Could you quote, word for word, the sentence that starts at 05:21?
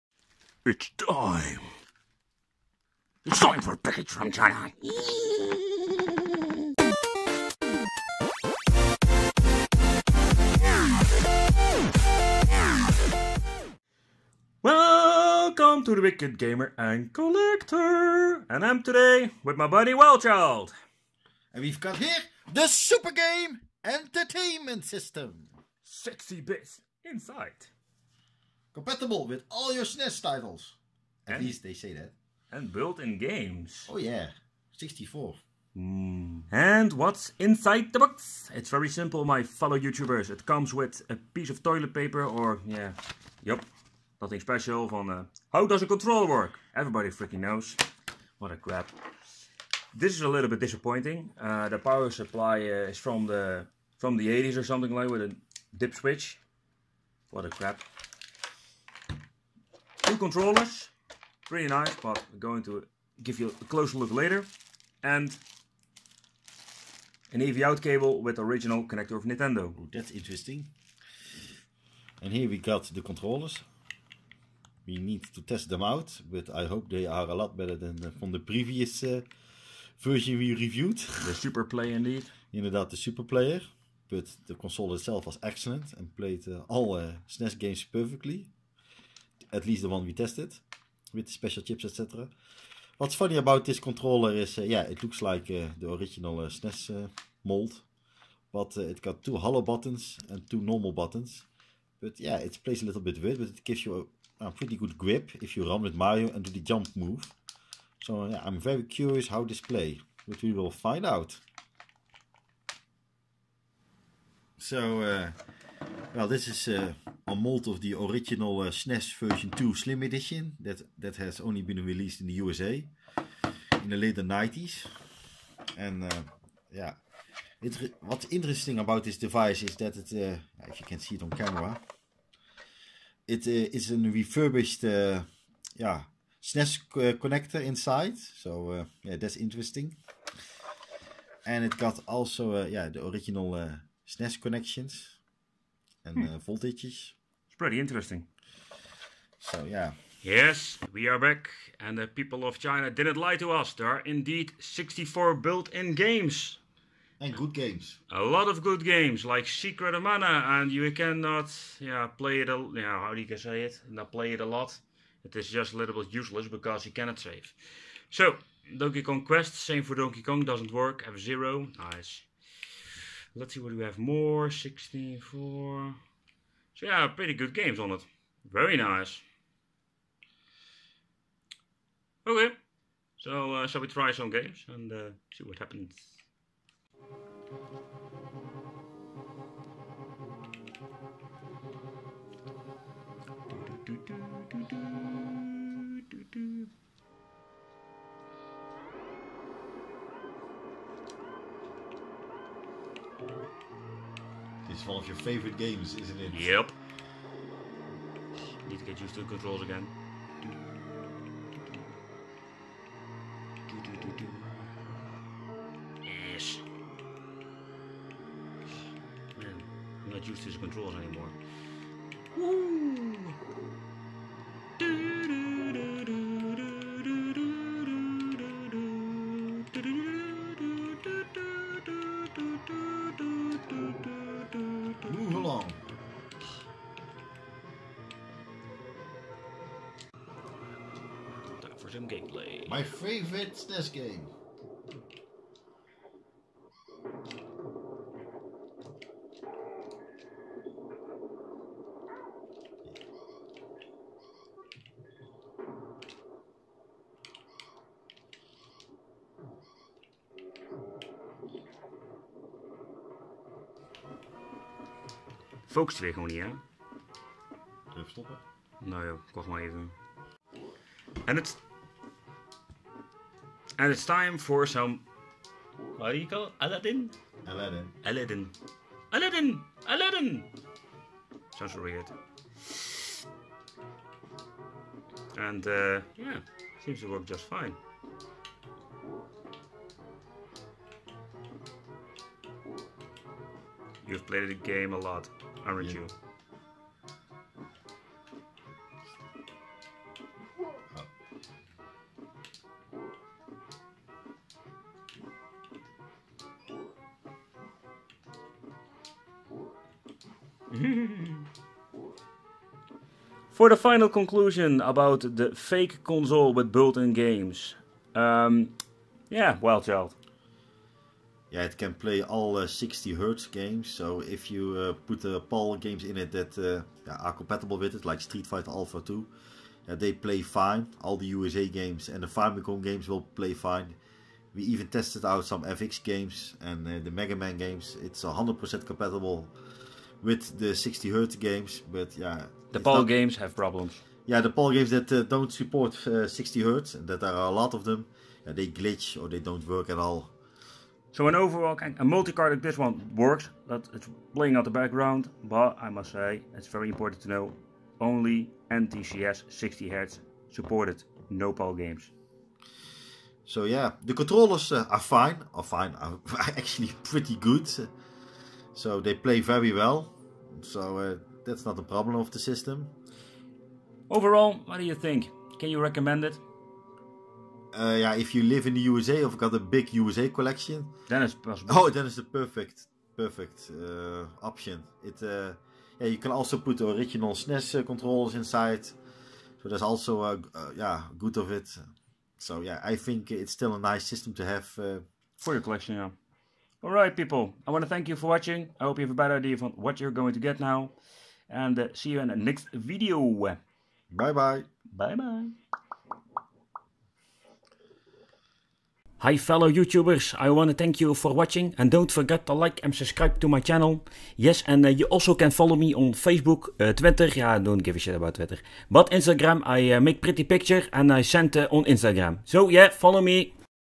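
Yeah, it can play all uh, 60 hertz games.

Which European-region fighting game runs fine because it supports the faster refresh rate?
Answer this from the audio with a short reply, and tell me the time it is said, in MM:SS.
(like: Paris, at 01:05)
Street Fighter Alpha 2, at 05:28.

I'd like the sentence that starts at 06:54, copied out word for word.
Yes, and uh, you also can follow me on Facebook, uh, Twitter, yeah, don't give a shit about Twitter.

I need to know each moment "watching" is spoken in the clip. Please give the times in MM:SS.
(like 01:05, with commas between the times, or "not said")
06:38, 06:51.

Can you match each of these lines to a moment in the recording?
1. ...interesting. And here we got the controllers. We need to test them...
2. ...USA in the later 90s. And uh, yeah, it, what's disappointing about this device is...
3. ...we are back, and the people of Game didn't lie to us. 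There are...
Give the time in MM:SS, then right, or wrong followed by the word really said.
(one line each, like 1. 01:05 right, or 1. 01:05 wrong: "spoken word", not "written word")
1. 01:10 right
2. 02:02 wrong: "interesting", not "disappointing"
3. 02:30 wrong: "China", not "Game".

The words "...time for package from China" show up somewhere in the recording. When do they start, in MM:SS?
00:03.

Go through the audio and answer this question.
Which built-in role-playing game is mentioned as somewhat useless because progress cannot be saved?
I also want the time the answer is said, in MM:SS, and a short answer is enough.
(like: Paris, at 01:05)
Secret of Mana, at 02:39.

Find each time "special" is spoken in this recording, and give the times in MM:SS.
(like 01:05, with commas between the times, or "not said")
00:44, 01:31.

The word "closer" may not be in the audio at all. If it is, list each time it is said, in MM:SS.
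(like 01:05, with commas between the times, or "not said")
01:03.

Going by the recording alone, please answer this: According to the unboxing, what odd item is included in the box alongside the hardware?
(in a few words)
Toilet paper.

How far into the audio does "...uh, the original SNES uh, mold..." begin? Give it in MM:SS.
01:35.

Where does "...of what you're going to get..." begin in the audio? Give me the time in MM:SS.
06:39.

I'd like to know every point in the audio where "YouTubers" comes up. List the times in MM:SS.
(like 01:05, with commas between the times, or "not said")
00:39, 06:49.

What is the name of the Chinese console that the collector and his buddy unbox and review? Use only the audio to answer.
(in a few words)
Super Game Entertainment System.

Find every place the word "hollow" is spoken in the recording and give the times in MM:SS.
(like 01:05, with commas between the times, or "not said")
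01:39.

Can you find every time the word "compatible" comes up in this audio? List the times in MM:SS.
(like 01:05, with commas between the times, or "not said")
00:28, 05:27, 05:38.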